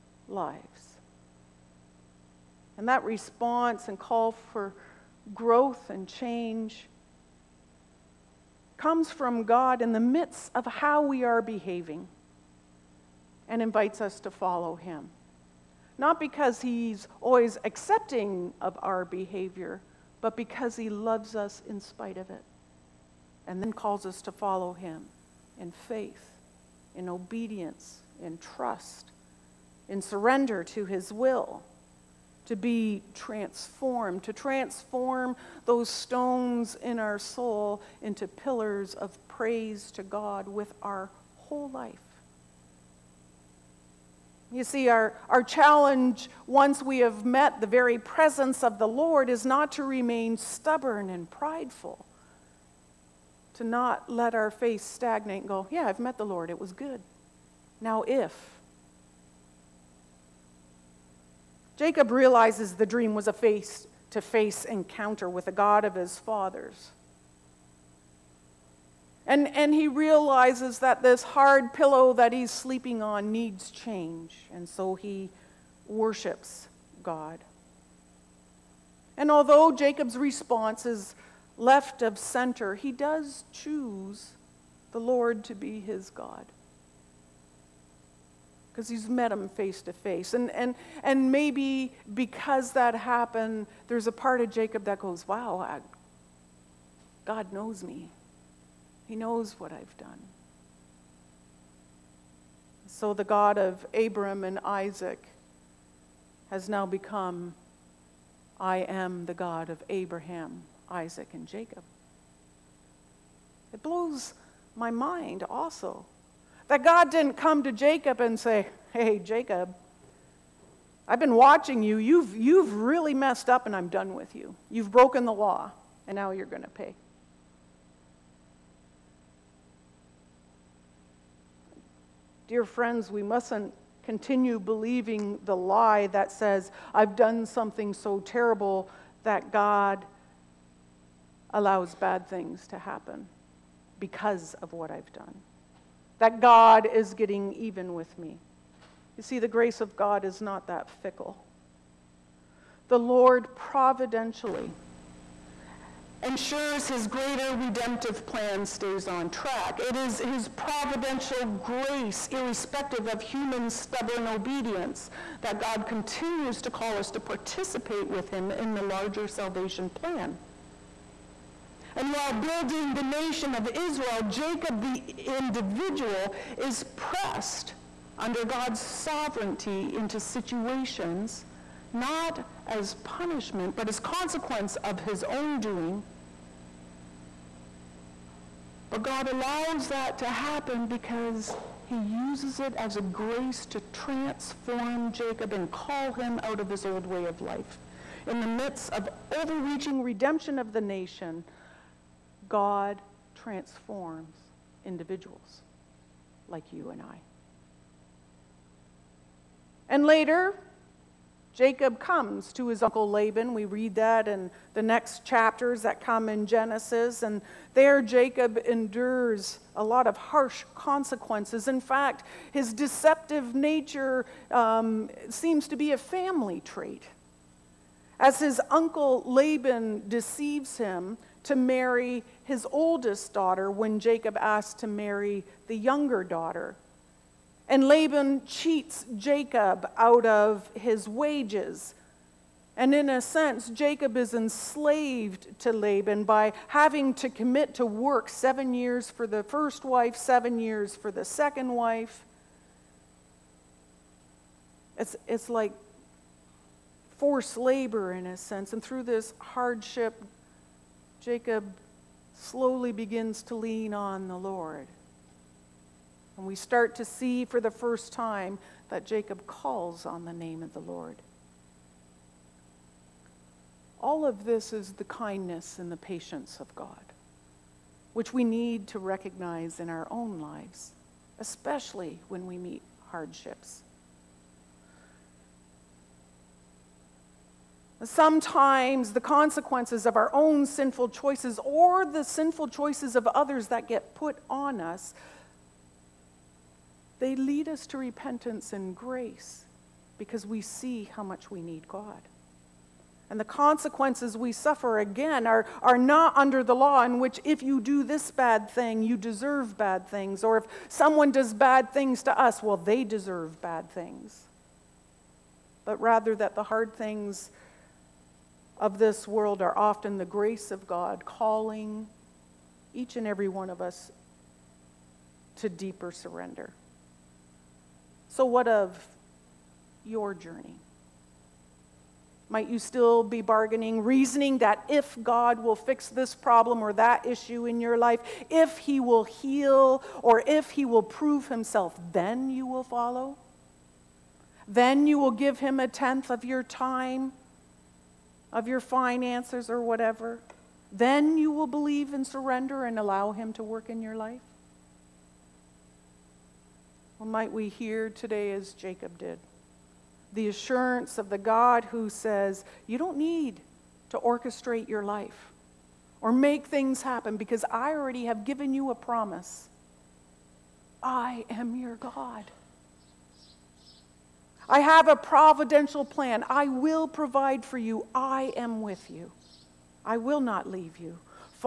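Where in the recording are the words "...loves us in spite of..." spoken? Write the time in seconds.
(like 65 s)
20 s.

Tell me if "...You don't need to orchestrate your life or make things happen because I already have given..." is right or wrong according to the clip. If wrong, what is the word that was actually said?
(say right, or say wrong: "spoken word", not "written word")
right.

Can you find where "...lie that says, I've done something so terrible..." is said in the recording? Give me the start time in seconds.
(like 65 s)
135 s.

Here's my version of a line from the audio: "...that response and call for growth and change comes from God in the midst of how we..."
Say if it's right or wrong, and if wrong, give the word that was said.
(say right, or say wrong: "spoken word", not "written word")
right.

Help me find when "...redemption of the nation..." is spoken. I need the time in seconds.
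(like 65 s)
200 s.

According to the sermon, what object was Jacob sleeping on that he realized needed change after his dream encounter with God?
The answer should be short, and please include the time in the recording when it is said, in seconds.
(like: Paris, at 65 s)
Hard pillow, at 71 s.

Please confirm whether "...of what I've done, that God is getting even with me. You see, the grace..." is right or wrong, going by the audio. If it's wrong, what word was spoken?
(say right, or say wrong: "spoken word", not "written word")
right.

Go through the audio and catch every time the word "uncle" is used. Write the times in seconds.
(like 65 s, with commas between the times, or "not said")
212 s, 228 s.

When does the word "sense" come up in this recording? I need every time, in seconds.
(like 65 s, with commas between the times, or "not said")
243 s, 258 s.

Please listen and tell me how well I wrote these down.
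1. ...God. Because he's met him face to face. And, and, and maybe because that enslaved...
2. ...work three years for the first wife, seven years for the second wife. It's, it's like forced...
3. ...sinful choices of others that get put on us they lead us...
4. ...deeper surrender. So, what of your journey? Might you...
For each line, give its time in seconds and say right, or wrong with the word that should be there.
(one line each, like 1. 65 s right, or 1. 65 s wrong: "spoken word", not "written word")
1. 86 s wrong: "happened", not "enslaved"
2. 247 s wrong: "seven", not "three"
3. 292 s right
4. 325 s right.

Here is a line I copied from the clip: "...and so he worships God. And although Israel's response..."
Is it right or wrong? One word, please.
wrong.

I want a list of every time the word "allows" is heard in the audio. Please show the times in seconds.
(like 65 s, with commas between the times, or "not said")
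141 s, 189 s, 352 s.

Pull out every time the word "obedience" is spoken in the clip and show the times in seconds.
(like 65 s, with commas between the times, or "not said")
27 s, 164 s.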